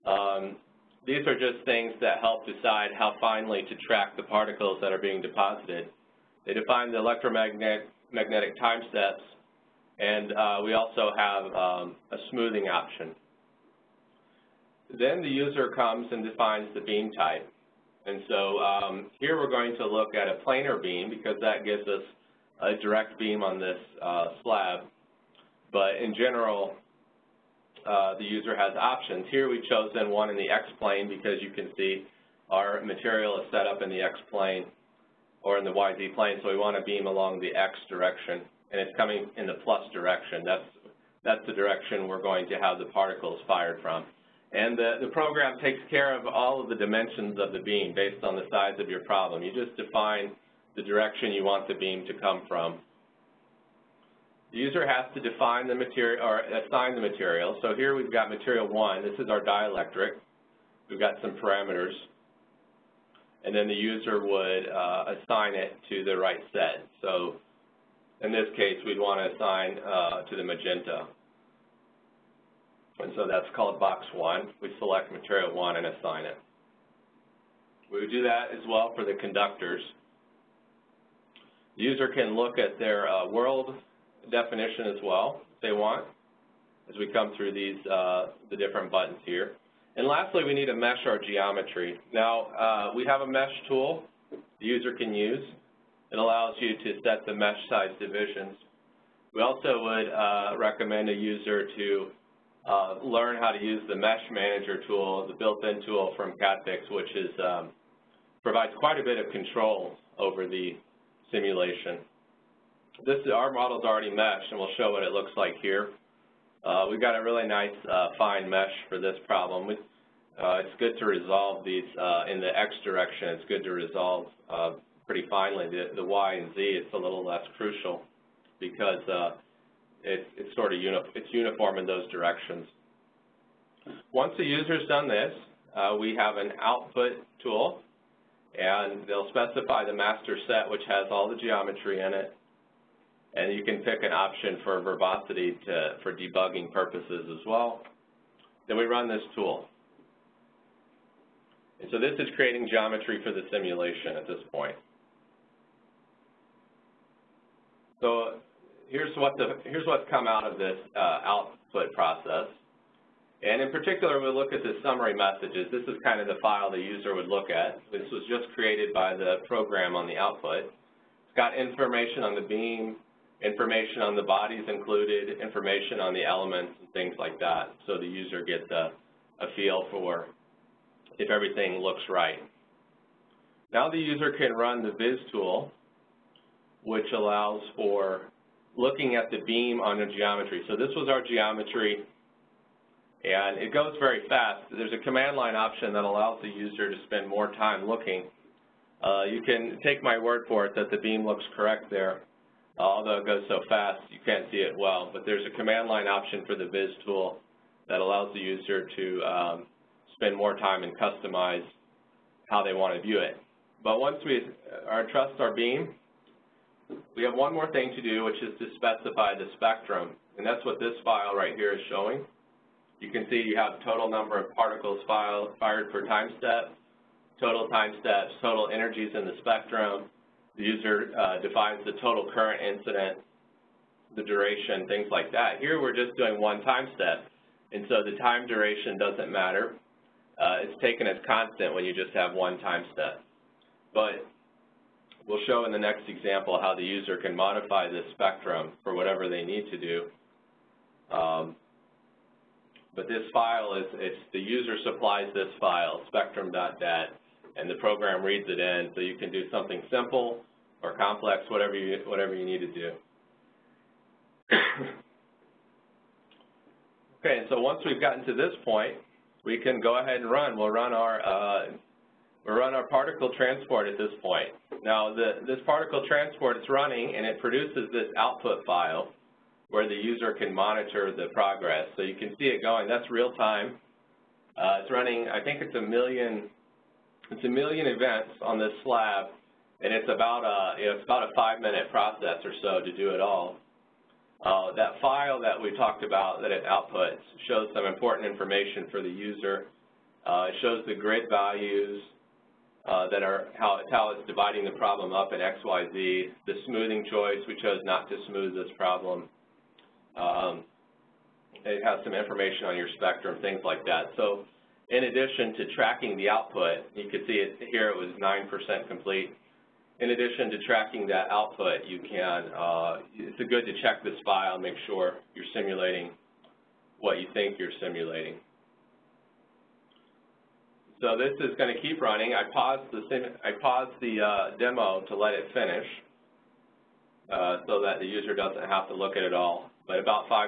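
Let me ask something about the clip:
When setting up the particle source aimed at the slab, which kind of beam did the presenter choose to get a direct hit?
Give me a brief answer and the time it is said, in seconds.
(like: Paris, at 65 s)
Planar beam, at 20 s.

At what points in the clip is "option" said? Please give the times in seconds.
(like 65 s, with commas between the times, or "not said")
12 s, 28 s, 144 s, 195 s, 206 s.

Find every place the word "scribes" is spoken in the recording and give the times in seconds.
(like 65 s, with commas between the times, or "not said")
not said.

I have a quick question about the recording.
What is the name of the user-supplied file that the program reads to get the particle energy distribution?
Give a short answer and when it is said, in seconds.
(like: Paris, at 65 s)
spectrum.dat, at 256 s.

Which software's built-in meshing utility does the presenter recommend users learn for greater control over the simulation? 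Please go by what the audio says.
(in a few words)
CADfix.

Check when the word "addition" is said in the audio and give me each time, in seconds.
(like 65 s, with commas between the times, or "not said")
315 s, 320 s.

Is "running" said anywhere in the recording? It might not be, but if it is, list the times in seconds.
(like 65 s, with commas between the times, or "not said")
276 s, 284 s, 332 s.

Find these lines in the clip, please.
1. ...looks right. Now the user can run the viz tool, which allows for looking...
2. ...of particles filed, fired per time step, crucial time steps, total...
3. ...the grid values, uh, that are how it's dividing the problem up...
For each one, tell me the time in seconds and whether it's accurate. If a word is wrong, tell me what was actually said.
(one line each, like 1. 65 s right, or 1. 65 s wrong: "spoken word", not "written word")
1. 181 s right
2. 224 s wrong: "total", not "crucial"
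3. 300 s right.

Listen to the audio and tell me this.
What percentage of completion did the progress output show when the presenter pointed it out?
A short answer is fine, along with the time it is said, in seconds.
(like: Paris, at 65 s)
9%, at 318 s.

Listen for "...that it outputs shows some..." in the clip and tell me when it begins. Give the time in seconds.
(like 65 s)
296 s.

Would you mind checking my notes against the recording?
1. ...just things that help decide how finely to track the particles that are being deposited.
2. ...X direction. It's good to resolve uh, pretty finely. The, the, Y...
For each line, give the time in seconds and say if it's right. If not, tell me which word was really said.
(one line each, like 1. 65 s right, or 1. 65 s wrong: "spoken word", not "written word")
1. 1 s right
2. 122 s right.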